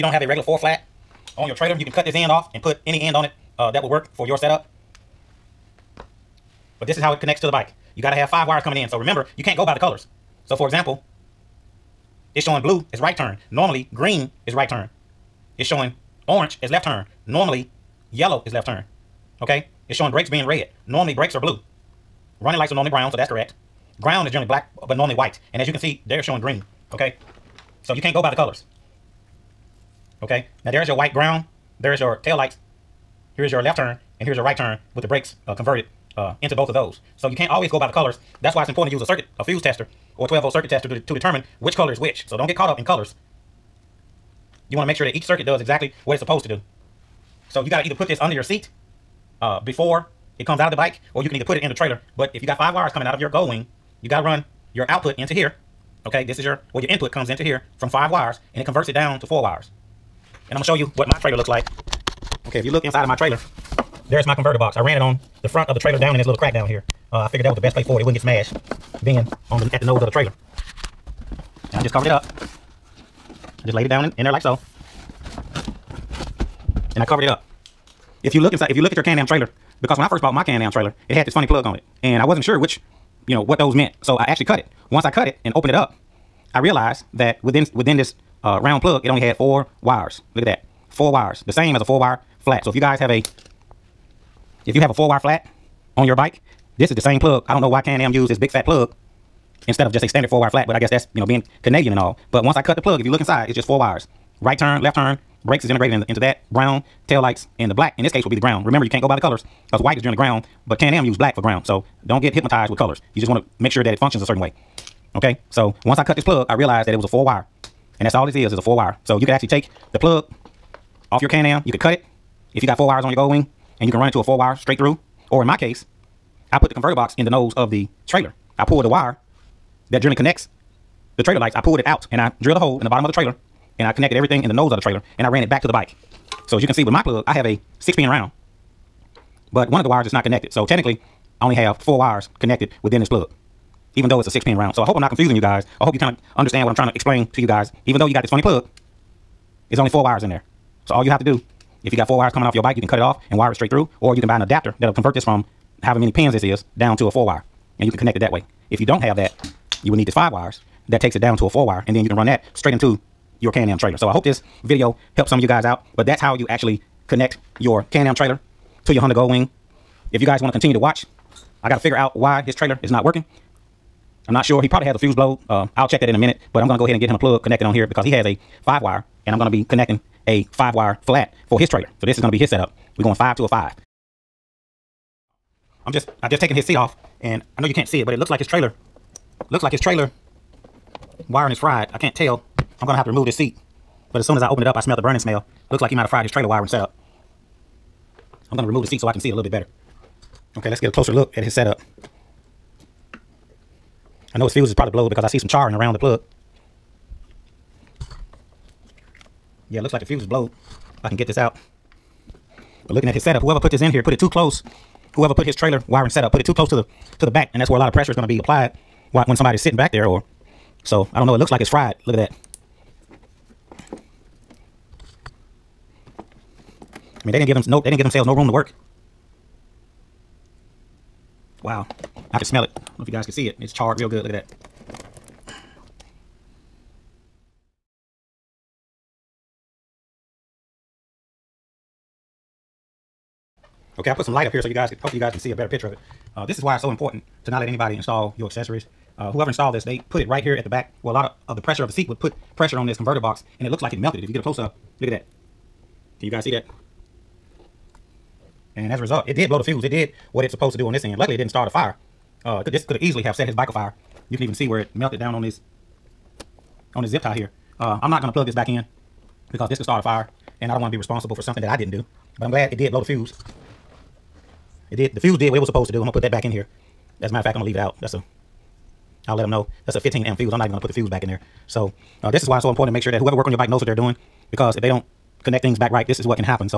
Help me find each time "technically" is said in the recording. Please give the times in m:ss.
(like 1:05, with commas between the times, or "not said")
2:20.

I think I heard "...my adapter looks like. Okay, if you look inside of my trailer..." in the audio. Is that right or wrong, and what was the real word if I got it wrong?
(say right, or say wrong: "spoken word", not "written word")
wrong: "trailer", not "adapter".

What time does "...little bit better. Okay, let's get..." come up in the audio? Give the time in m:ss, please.
3:19.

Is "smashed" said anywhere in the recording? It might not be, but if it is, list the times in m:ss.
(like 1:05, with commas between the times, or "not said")
1:08.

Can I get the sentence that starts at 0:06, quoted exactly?
But this is how it connects to the bike.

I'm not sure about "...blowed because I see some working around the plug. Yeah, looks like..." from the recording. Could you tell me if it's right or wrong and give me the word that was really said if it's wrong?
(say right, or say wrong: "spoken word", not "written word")
wrong: "charring", not "working".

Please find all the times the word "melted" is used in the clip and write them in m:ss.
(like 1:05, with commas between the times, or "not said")
4:13, 4:24.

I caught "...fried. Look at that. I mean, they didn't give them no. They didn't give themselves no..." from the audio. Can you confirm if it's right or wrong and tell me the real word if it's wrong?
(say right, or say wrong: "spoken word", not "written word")
right.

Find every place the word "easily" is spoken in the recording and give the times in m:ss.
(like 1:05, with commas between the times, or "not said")
4:23.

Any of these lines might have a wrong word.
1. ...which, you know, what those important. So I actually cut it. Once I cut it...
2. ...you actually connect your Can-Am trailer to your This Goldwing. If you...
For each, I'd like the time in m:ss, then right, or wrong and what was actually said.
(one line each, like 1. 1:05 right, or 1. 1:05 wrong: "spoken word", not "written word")
1. 1:22 wrong: "meant", not "important"
2. 2:46 wrong: "Honda", not "This".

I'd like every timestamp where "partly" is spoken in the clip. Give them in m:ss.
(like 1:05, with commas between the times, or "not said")
not said.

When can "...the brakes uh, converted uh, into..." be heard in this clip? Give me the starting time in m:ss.
0:35.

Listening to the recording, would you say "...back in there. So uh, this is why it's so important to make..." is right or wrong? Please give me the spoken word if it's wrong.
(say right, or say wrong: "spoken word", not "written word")
right.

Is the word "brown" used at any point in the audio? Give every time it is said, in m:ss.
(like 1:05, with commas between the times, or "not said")
0:22, 1:46.